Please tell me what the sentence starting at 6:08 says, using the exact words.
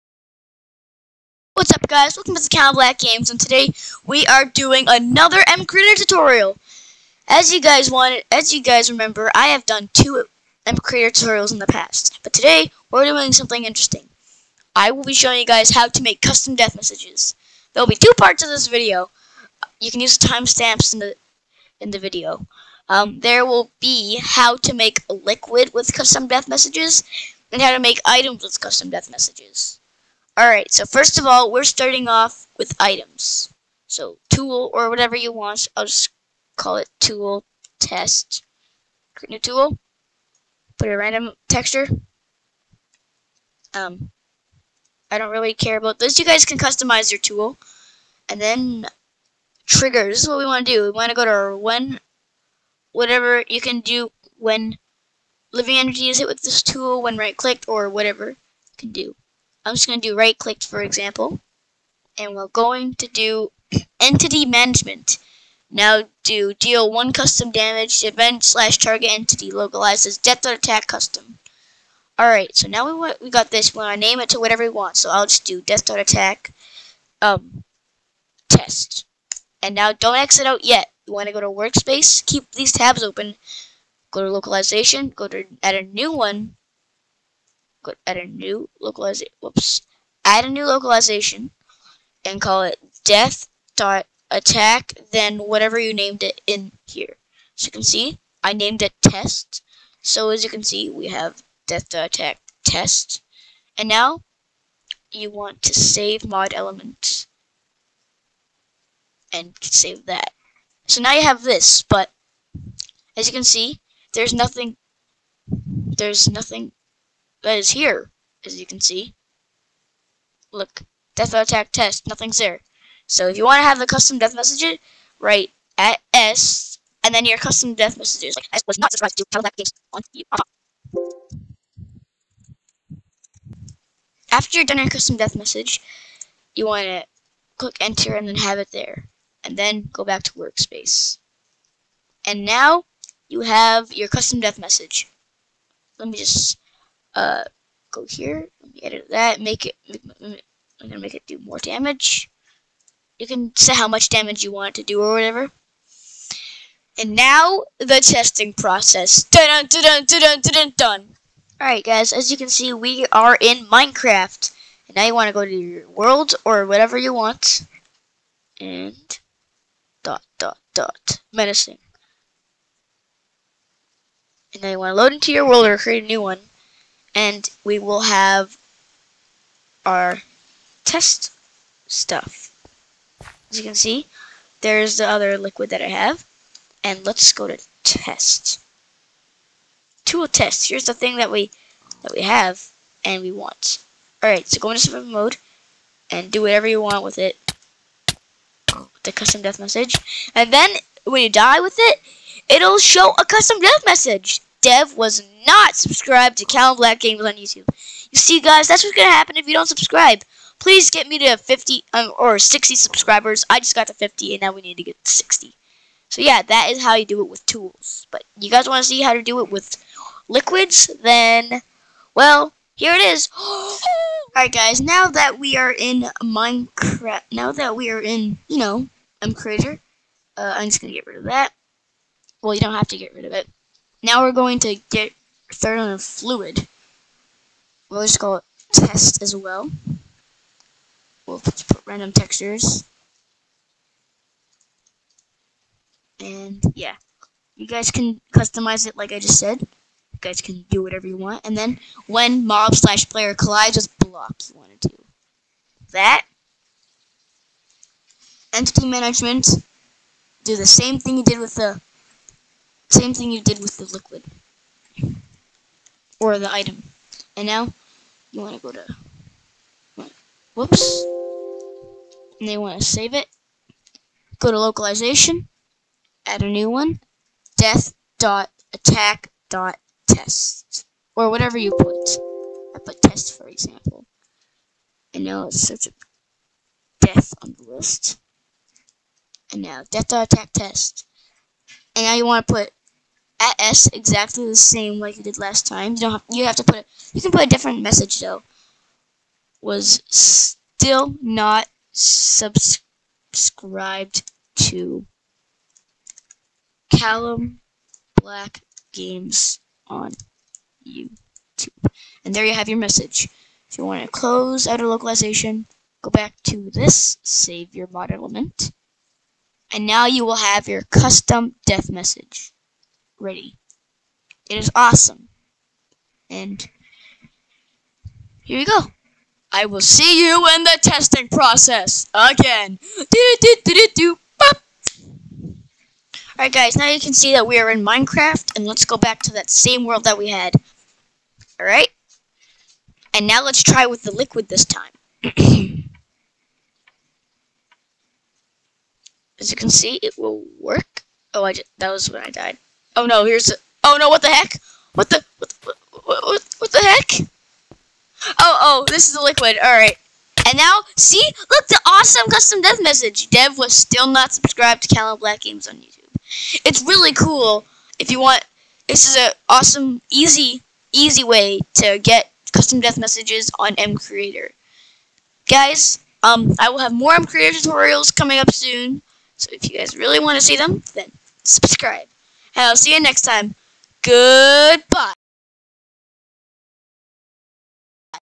This is an awesome, easy, easy way to get custom death messages on M Creator.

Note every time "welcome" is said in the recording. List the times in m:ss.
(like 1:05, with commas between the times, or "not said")
0:02.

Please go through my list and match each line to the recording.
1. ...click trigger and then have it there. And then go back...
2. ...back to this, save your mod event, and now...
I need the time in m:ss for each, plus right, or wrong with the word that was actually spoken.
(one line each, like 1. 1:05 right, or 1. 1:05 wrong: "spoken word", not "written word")
1. 2:17 wrong: "enter", not "trigger"
2. 5:16 wrong: "element", not "event".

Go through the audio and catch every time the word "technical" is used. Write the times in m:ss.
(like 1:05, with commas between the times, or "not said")
not said.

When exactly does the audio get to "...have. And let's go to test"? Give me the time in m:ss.
3:05.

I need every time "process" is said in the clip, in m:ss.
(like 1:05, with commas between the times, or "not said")
2:38, 5:31.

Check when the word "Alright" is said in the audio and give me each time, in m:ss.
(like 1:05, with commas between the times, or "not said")
0:30, 1:12, 3:14, 3:44, 5:36, 5:41, 5:59.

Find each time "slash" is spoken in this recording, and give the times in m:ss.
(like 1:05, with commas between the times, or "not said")
1:08, 4:12.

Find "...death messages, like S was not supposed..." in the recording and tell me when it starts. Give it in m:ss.
2:07.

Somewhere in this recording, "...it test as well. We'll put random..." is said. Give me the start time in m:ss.
3:58.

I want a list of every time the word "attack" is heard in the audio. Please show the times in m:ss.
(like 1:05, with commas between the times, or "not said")
1:10, 1:15, 1:34, 1:42, 2:01, 4:38, 4:50.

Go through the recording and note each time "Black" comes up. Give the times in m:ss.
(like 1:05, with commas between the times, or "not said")
0:02, 3:26, 5:08, 6:05.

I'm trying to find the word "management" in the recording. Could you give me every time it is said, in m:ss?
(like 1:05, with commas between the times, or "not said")
1:04, 4:18.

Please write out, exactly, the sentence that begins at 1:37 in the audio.
So you can see I named it test.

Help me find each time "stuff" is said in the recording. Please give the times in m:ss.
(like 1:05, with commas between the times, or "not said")
3:01.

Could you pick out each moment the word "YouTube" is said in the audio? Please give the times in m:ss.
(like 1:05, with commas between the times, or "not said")
3:27, 5:10, 6:05.